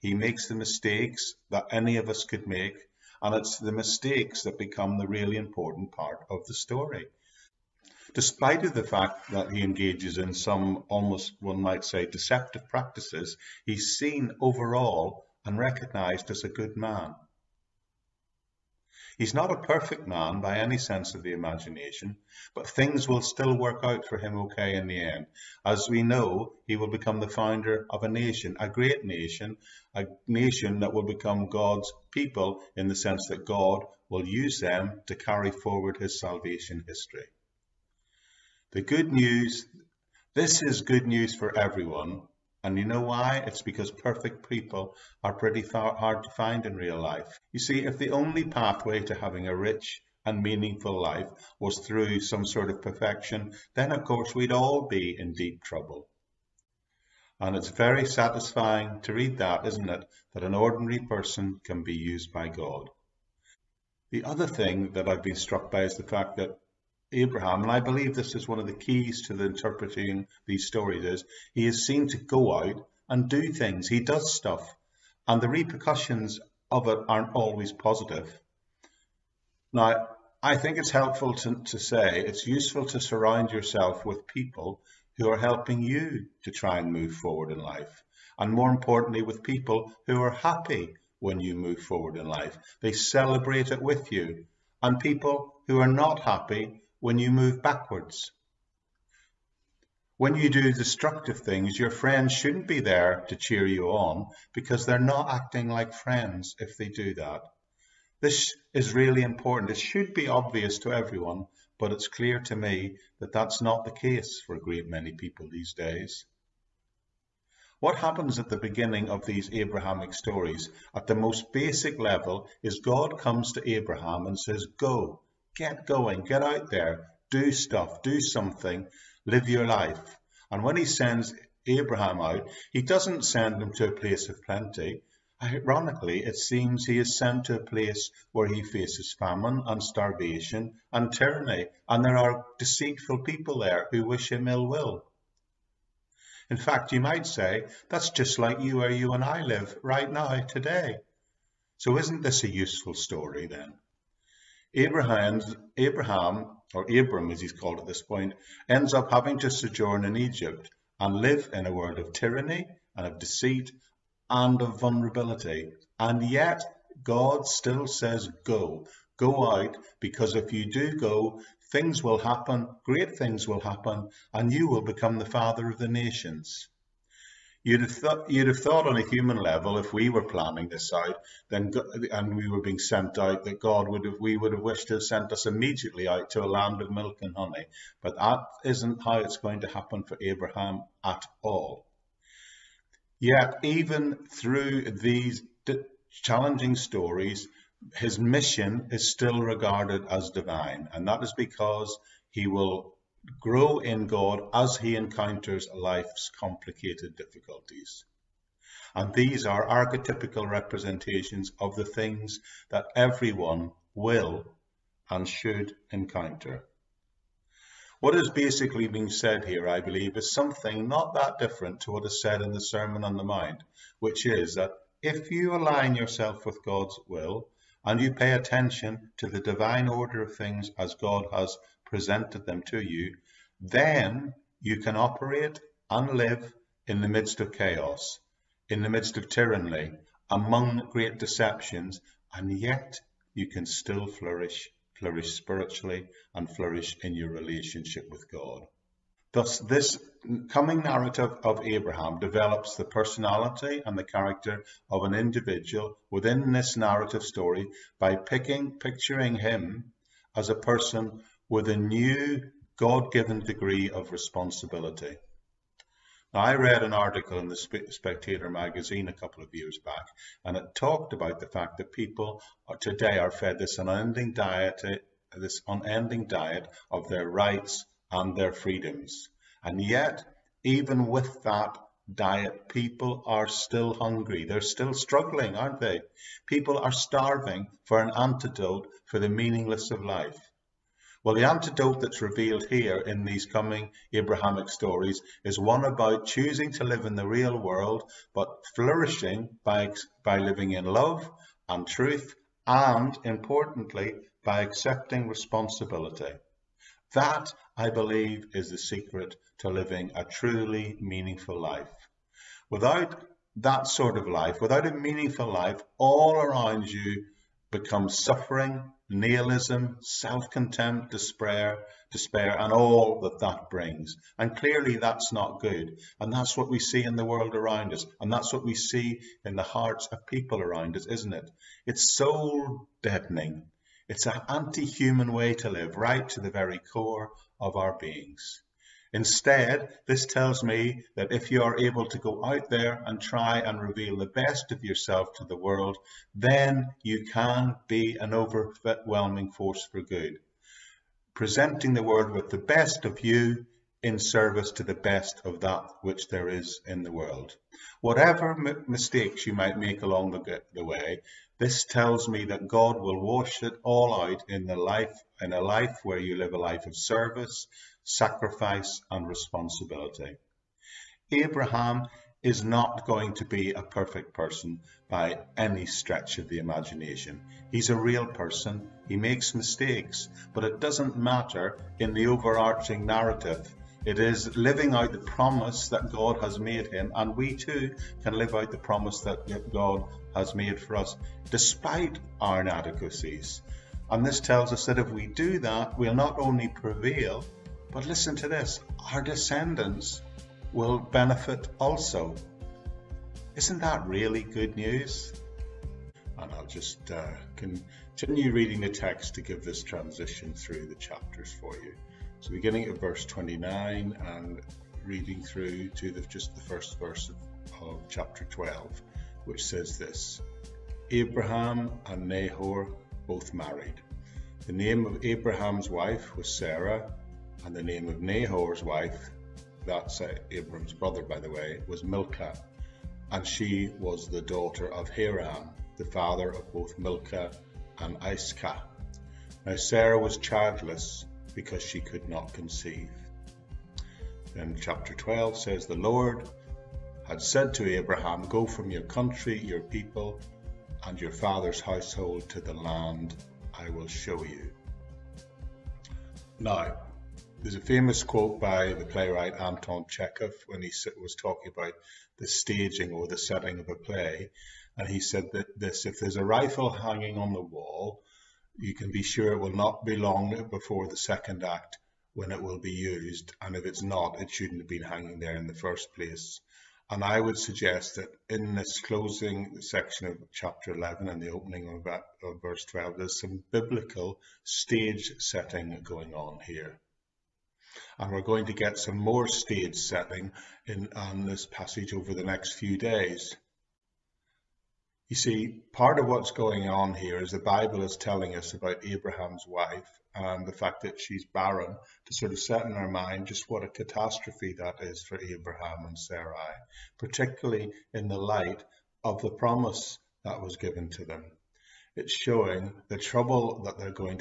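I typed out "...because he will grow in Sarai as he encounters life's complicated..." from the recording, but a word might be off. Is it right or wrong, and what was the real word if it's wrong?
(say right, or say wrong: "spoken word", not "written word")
wrong: "God", not "Sarai".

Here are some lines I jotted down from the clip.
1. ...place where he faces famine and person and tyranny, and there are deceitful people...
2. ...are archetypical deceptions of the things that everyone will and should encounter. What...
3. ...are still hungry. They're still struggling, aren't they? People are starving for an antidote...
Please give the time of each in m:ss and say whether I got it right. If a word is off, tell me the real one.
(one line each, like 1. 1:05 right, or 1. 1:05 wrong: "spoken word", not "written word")
1. 2:17 wrong: "starvation", not "person"
2. 3:29 wrong: "representations", not "deceptions"
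3. 4:43 right.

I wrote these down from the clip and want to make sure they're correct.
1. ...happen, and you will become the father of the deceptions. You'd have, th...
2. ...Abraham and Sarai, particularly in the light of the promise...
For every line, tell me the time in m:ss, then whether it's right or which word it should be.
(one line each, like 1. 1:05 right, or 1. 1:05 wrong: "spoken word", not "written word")
1. 2:53 wrong: "nations", not "deceptions"
2. 8:25 right.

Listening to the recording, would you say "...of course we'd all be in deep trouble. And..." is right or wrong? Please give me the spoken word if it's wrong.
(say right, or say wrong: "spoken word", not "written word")
right.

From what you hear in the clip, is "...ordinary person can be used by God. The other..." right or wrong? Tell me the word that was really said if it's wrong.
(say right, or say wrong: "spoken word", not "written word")
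right.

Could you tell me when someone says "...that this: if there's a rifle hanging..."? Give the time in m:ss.
7:45.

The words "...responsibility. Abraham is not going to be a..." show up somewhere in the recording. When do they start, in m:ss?
6:09.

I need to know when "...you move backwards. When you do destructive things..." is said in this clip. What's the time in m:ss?
1:37.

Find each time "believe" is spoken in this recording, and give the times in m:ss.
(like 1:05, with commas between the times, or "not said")
1:07, 3:39, 5:07.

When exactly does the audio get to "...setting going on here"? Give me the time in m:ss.
8:05.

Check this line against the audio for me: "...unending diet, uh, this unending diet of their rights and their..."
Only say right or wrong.
right.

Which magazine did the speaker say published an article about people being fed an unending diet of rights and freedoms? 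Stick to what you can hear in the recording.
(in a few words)
The Spectator.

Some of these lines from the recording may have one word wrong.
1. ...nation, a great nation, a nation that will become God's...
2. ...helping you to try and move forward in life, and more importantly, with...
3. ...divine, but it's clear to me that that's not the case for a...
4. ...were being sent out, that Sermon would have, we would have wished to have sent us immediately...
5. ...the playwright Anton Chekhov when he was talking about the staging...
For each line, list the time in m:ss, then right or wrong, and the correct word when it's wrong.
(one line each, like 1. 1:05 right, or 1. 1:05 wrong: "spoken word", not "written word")
1. 0:28 right
2. 1:25 right
3. 1:50 wrong: "everyone", not "divine"
4. 3:02 wrong: "God", not "Sermon"
5. 7:38 right.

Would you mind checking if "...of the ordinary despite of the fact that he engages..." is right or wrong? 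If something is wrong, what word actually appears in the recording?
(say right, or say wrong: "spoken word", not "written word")
wrong: "story", not "ordinary".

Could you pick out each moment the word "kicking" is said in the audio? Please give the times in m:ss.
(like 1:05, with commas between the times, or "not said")
not said.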